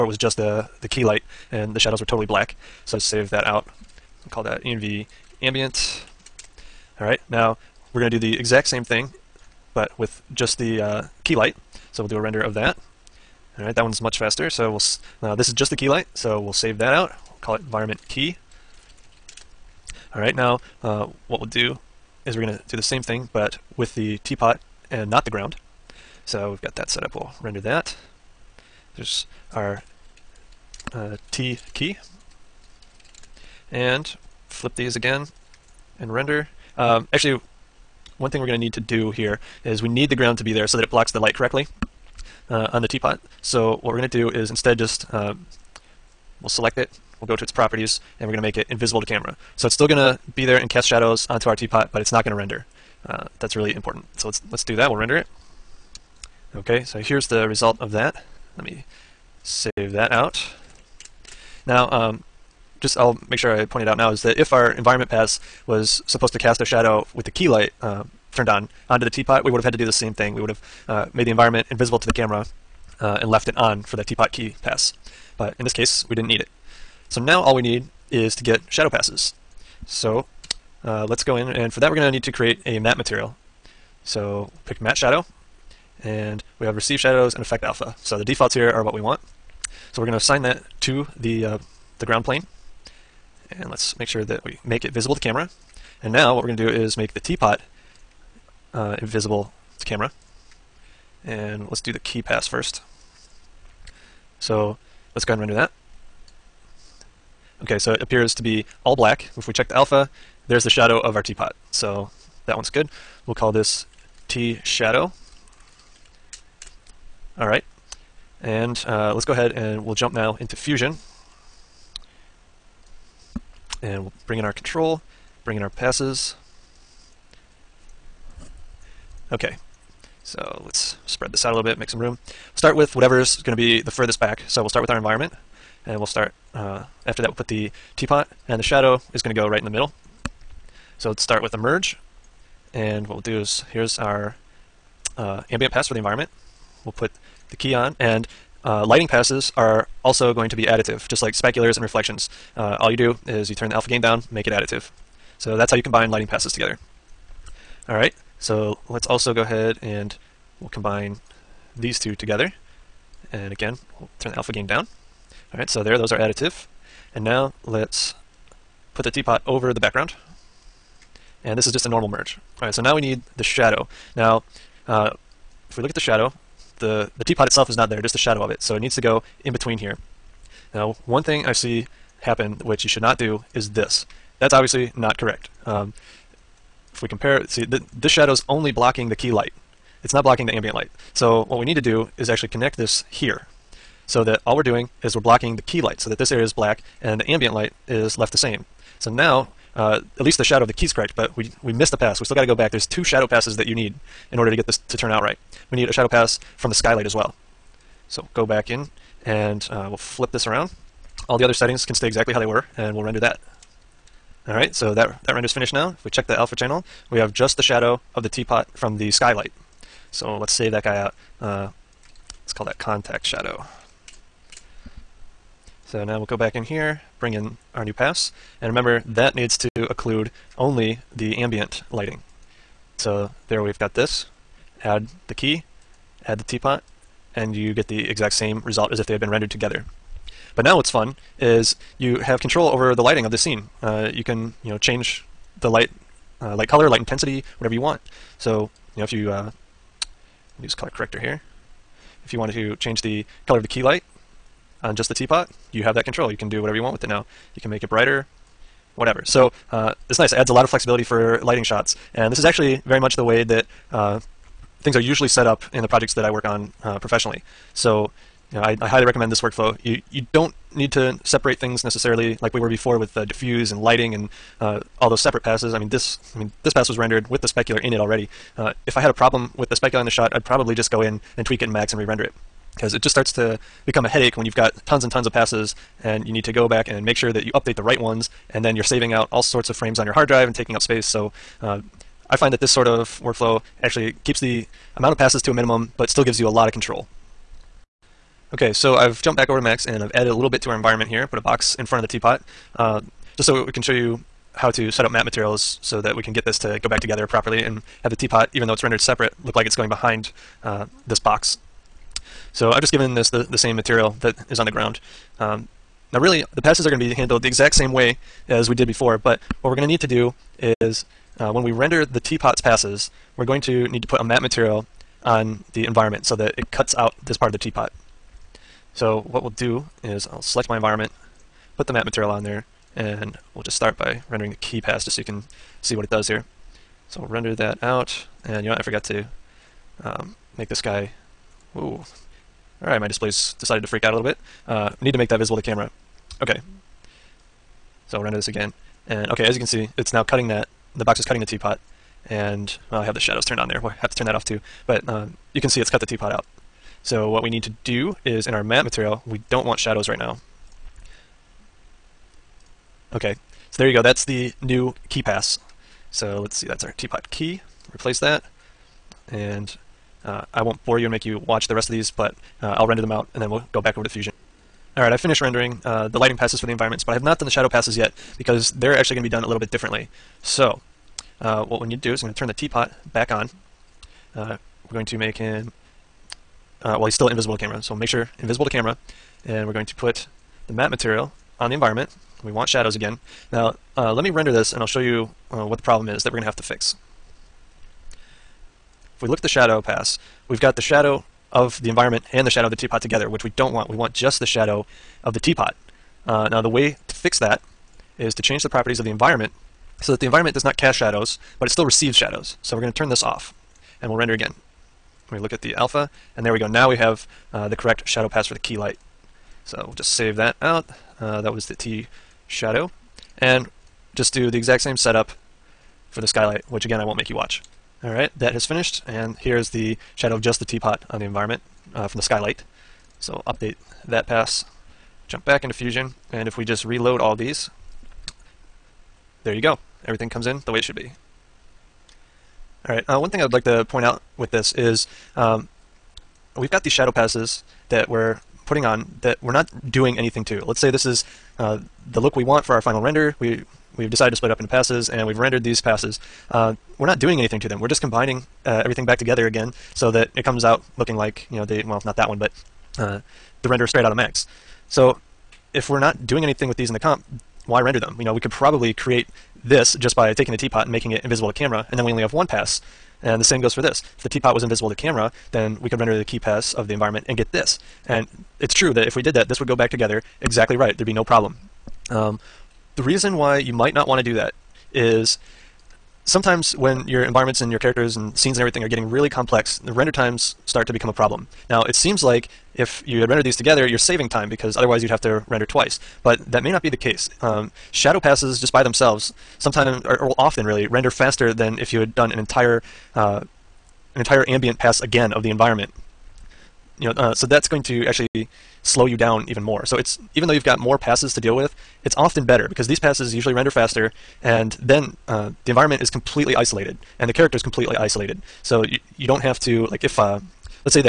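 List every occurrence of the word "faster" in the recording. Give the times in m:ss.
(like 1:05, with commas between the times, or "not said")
0:14, 8:21, 8:33.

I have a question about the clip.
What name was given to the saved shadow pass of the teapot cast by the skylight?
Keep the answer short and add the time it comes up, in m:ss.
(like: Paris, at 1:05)
contact shadow, at 3:42.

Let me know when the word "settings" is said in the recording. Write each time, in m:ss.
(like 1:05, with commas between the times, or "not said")
3:31.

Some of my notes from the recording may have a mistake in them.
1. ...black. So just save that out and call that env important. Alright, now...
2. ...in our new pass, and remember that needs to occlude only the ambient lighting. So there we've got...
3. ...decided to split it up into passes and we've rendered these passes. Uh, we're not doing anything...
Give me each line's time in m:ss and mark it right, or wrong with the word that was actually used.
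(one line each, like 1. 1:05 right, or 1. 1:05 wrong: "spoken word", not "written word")
1. 0:02 wrong: "ambient", not "important"
2. 3:47 right
3. 7:34 right.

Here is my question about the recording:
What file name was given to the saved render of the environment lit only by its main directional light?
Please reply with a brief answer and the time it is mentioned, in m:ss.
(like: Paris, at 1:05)
environment key, at 0:17.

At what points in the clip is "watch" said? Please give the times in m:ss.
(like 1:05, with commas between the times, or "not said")
6:11, 7:07.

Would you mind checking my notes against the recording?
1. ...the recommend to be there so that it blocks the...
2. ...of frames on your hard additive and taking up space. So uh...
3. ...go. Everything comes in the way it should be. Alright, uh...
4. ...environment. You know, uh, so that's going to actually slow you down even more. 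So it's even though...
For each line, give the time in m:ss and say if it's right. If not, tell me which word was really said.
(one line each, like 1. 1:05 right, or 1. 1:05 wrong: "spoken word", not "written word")
1. 0:40 wrong: "ground", not "recommend"
2. 4:49 wrong: "drive", not "additive"
3. 7:19 right
4. 8:25 right.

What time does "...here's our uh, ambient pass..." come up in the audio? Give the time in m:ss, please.
2:23.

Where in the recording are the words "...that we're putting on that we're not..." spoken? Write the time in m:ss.
7:27.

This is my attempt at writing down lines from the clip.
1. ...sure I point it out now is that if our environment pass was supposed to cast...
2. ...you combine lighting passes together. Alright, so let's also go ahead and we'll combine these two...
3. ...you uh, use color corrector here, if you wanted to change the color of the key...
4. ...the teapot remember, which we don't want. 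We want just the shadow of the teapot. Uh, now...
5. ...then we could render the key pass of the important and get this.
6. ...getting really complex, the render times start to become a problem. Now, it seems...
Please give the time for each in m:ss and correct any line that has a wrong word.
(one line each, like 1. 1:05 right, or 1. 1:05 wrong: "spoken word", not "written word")
1. 1:03 right
2. 2:35 right
3. 4:09 right
4. 6:42 wrong: "together", not "remember"
5. 7:55 wrong: "environment", not "important"
6. 8:08 right.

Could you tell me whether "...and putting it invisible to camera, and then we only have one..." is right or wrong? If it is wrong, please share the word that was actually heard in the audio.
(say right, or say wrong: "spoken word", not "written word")
wrong: "making", not "putting".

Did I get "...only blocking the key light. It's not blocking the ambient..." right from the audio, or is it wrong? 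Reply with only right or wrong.
right.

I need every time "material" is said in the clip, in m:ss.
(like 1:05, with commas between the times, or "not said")
1:22, 5:05, 5:13, 5:24, 5:32, 5:58, 6:30.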